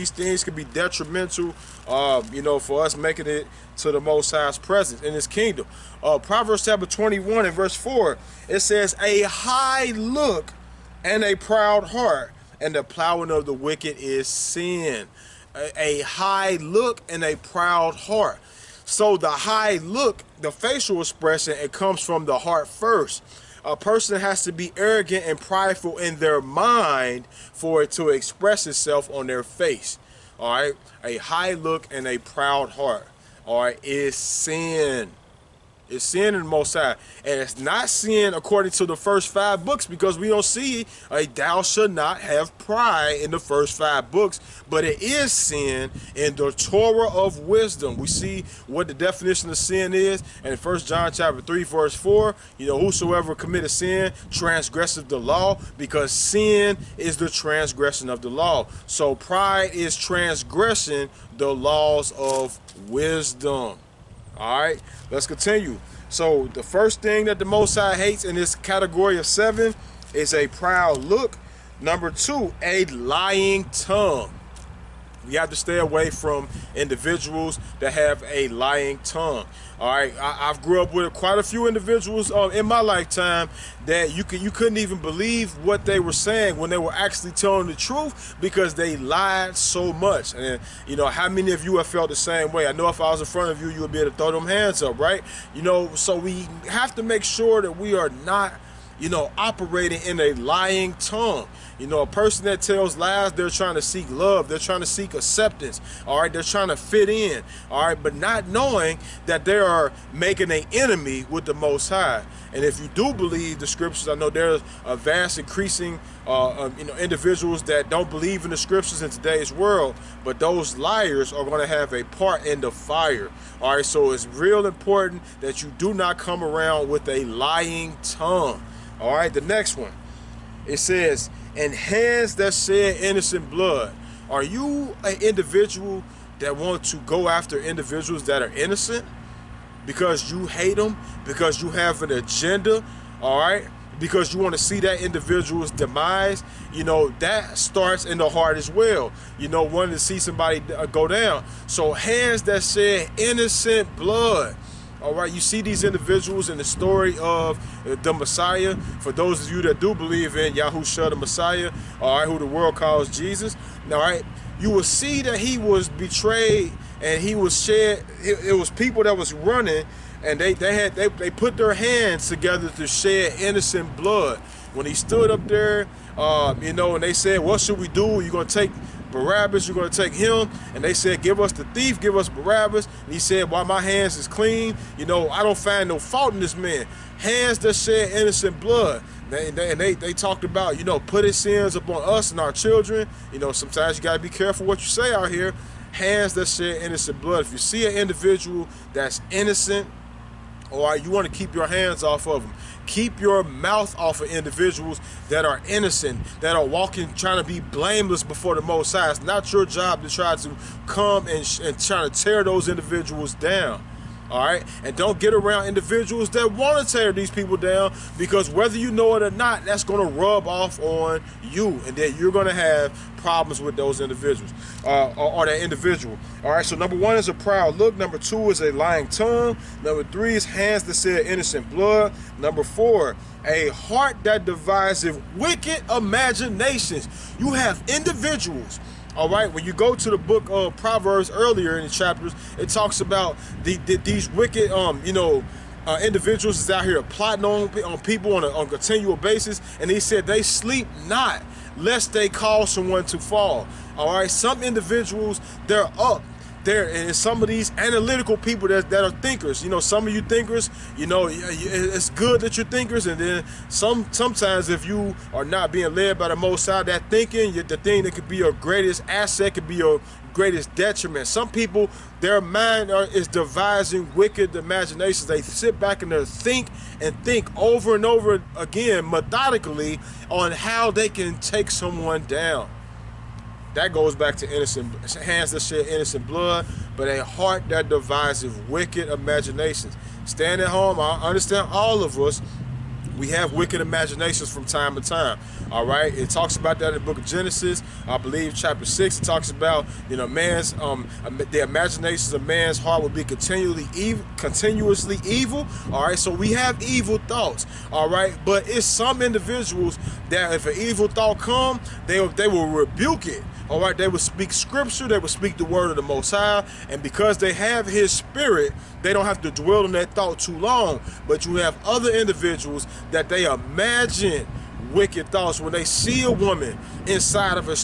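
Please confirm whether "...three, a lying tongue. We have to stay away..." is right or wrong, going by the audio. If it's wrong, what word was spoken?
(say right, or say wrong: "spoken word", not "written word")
wrong: "two", not "three".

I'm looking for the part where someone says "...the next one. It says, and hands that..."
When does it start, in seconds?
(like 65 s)
129 s.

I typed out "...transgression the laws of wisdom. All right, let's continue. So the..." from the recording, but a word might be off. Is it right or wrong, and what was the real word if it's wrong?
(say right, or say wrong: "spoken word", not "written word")
right.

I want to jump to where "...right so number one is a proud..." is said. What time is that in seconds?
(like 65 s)
226 s.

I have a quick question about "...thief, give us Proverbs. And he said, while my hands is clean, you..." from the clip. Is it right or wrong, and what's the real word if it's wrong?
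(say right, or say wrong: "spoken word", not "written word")
wrong: "Barabbas", not "Proverbs".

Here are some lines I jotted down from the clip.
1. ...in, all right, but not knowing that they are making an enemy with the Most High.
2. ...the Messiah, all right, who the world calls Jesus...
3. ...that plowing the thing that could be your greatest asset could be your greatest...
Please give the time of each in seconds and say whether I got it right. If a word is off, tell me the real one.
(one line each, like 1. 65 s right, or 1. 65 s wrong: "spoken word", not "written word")
1. 107 s right
2. 161 s right
3. 266 s wrong: "thinking", not "plowing".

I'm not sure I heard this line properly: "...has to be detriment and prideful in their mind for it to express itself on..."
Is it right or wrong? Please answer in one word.
wrong.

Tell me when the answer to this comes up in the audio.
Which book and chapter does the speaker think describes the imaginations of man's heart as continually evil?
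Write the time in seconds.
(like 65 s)
297 s.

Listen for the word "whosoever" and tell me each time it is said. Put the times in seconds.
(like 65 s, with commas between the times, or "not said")
52 s.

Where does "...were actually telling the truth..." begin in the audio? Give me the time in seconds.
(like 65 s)
86 s.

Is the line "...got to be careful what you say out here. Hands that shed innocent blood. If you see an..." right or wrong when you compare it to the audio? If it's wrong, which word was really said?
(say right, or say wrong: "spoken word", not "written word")
right.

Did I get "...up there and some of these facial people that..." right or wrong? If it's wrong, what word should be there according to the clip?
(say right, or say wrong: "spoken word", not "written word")
wrong: "analytical", not "facial".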